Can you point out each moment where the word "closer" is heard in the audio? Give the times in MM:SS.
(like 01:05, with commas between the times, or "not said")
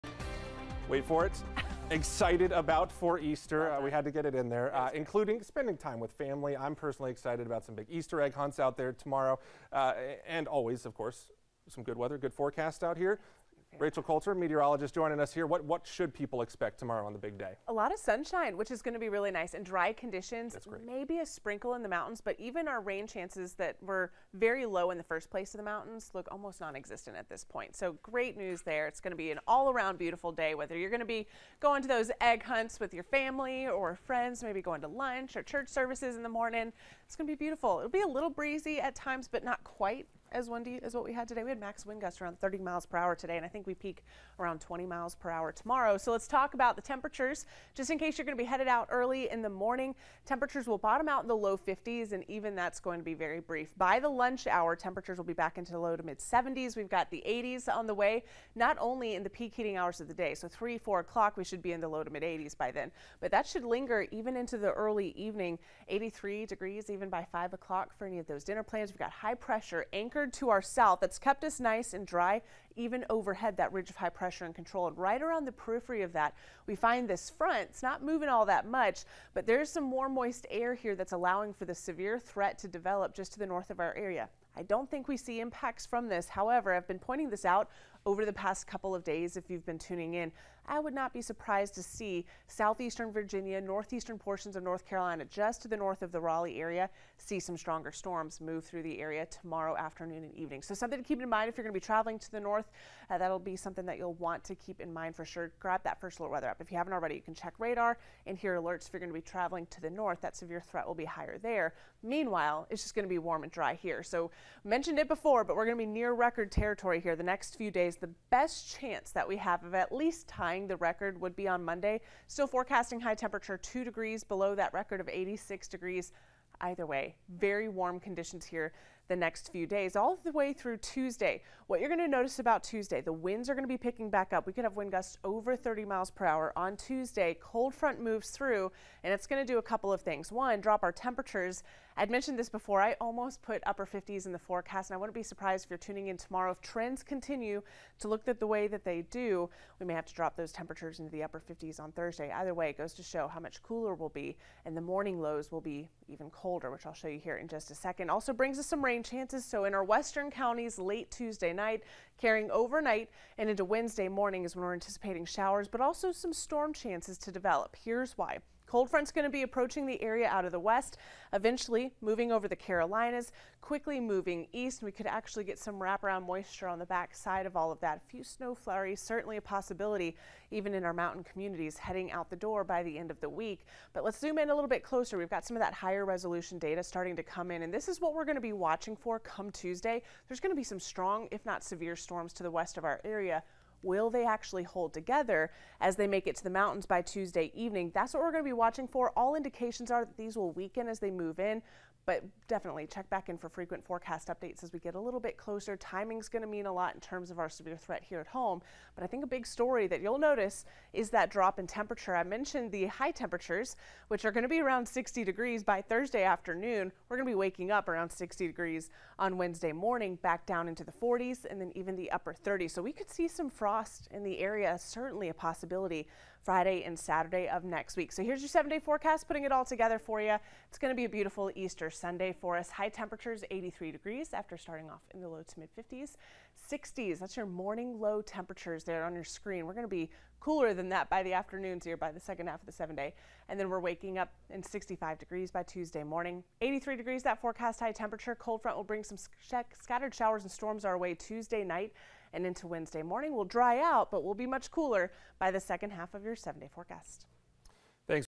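03:04, 03:25.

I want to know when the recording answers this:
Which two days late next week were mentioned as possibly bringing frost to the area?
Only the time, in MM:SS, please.
03:46.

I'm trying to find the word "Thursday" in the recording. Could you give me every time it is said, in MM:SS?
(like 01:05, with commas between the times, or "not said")
02:31, 03:35.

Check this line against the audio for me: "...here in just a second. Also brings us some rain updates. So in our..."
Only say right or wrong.
wrong.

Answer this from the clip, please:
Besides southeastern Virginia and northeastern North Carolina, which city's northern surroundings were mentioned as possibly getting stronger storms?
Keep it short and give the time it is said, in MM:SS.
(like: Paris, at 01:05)
Raleigh, at 01:36.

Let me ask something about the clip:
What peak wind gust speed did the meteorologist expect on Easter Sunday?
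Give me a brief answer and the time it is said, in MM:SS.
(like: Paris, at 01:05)
20 miles per hour, at 00:44.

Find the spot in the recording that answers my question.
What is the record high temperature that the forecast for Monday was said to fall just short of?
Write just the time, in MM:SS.
02:05.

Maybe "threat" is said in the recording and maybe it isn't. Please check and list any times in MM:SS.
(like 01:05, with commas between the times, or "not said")
01:22, 01:50, 03:27.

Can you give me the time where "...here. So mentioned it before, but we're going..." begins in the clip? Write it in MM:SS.
01:53.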